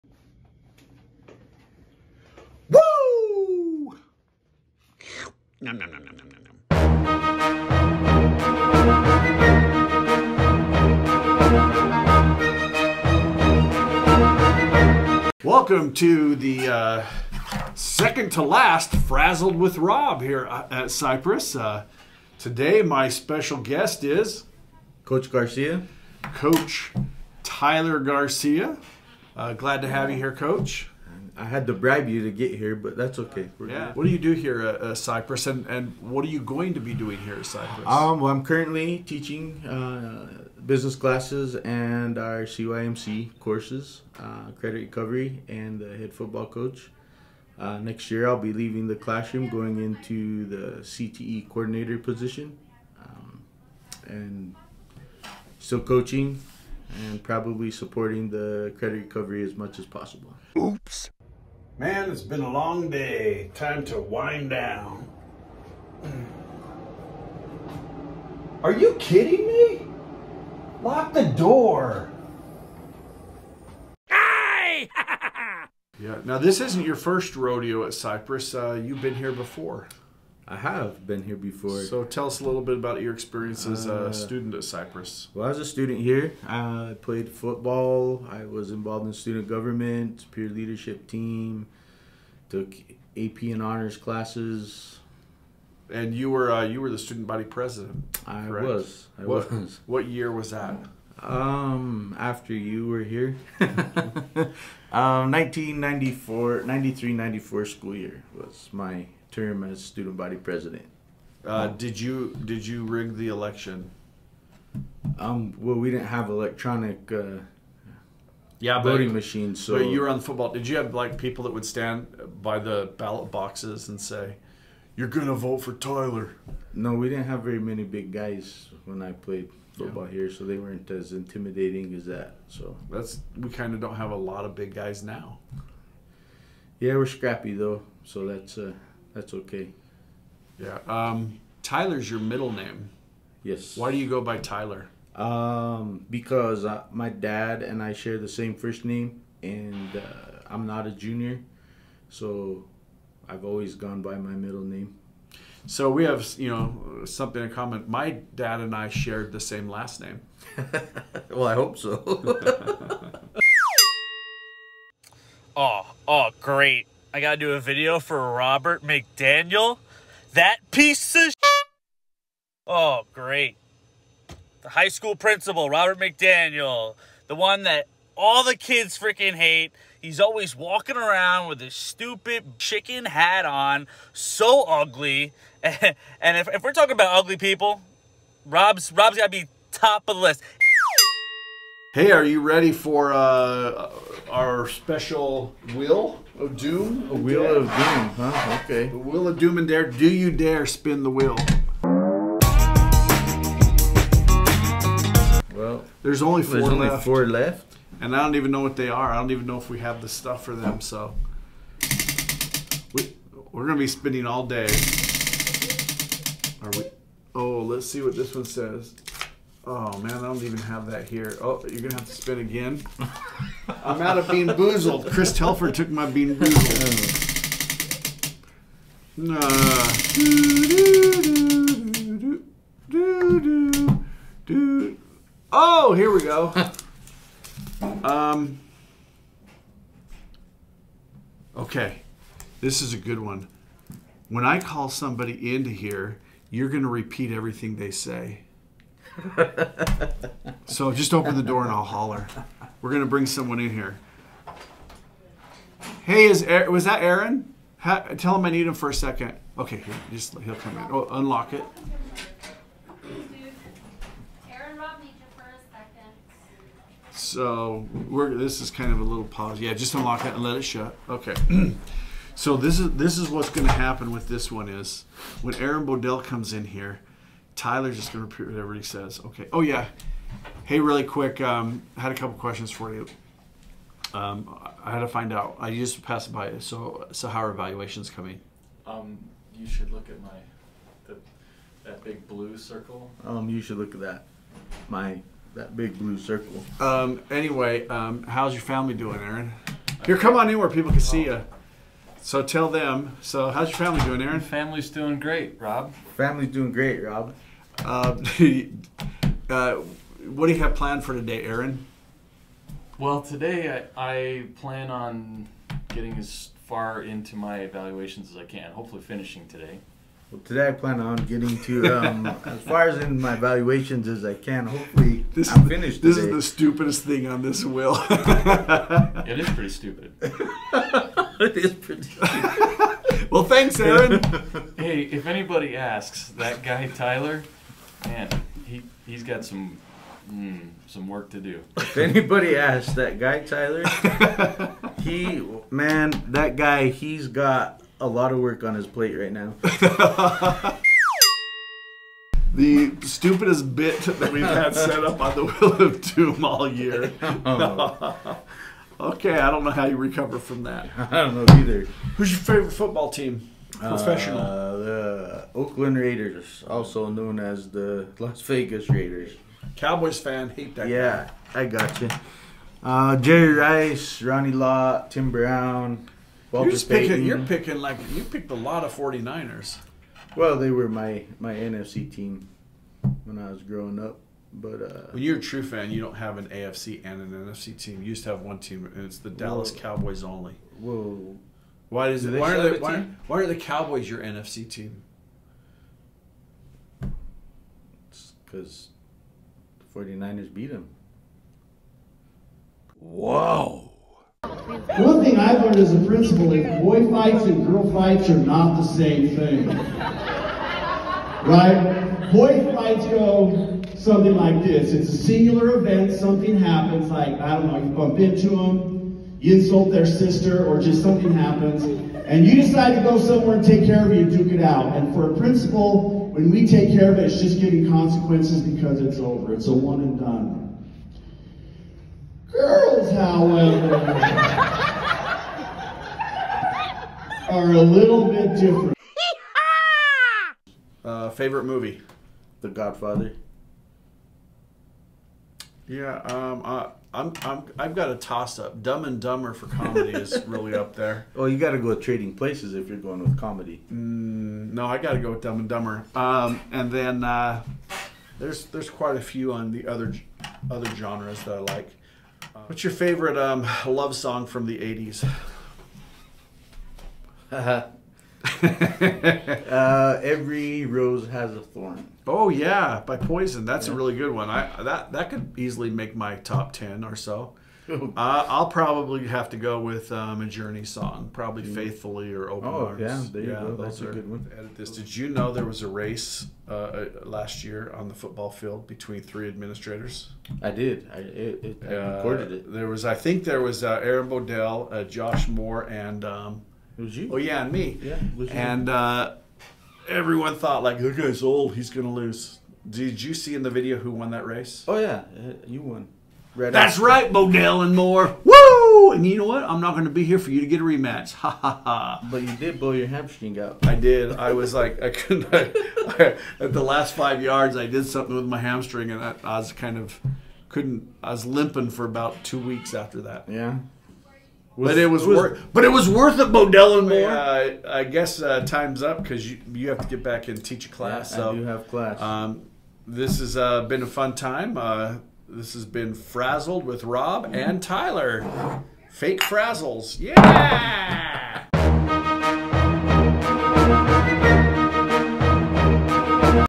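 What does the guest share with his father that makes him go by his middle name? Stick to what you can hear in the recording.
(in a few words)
The same first name.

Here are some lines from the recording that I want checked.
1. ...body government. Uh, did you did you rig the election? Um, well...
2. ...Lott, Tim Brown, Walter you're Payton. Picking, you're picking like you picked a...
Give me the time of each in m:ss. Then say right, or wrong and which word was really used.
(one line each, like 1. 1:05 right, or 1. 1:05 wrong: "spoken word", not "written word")
1. 1:50 wrong: "president", not "government"
2. 6:14 right.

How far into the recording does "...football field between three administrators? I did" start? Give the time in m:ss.
8:08.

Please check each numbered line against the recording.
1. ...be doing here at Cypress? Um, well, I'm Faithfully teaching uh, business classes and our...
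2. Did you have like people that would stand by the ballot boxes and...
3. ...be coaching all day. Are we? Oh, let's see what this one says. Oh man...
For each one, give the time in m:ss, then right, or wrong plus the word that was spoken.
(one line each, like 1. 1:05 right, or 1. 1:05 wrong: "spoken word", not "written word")
1. 0:36 wrong: "currently", not "Faithfully"
2. 2:00 right
3. 3:33 wrong: "spinning", not "coaching".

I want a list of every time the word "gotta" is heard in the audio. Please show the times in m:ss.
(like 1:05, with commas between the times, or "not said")
2:47, 3:09.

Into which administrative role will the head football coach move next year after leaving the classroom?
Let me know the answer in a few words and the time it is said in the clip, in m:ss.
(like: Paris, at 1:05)
CTE coordinator, at 0:50.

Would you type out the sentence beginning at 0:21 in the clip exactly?
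Uh, today, my special guest is Coach Garcia.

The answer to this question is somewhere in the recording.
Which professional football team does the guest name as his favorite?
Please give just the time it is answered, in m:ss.
6:08.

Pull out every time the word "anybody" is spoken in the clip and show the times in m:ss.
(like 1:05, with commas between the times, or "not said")
5:35, 5:41.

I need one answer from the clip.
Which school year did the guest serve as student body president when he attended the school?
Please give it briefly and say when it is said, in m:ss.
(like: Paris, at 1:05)
1993-94, at 1:46.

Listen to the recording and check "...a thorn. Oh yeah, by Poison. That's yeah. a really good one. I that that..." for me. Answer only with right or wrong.
right.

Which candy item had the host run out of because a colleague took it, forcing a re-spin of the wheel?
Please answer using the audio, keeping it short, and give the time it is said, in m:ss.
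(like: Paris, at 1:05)
BeanBoozled, at 3:44.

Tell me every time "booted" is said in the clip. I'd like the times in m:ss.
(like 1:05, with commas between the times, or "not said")
not said.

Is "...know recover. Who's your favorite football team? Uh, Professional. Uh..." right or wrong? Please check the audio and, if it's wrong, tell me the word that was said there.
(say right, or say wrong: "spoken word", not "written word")
wrong: "either", not "recover".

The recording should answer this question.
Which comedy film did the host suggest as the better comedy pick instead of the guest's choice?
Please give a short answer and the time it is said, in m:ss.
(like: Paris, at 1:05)
Trading Places, at 7:32.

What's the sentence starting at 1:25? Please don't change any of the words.
Well, as a student here, I played football.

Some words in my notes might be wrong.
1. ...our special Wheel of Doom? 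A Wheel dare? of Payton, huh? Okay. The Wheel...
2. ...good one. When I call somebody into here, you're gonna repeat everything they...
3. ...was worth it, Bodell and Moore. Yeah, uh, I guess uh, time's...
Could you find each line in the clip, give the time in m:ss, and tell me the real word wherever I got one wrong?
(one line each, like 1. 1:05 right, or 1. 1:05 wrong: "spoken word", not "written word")
1. 3:14 wrong: "Doom", not "Payton"
2. 4:02 right
3. 8:45 right.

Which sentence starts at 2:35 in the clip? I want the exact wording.
So we have, you know, something in common.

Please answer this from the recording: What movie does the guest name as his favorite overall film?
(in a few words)
The Godfather.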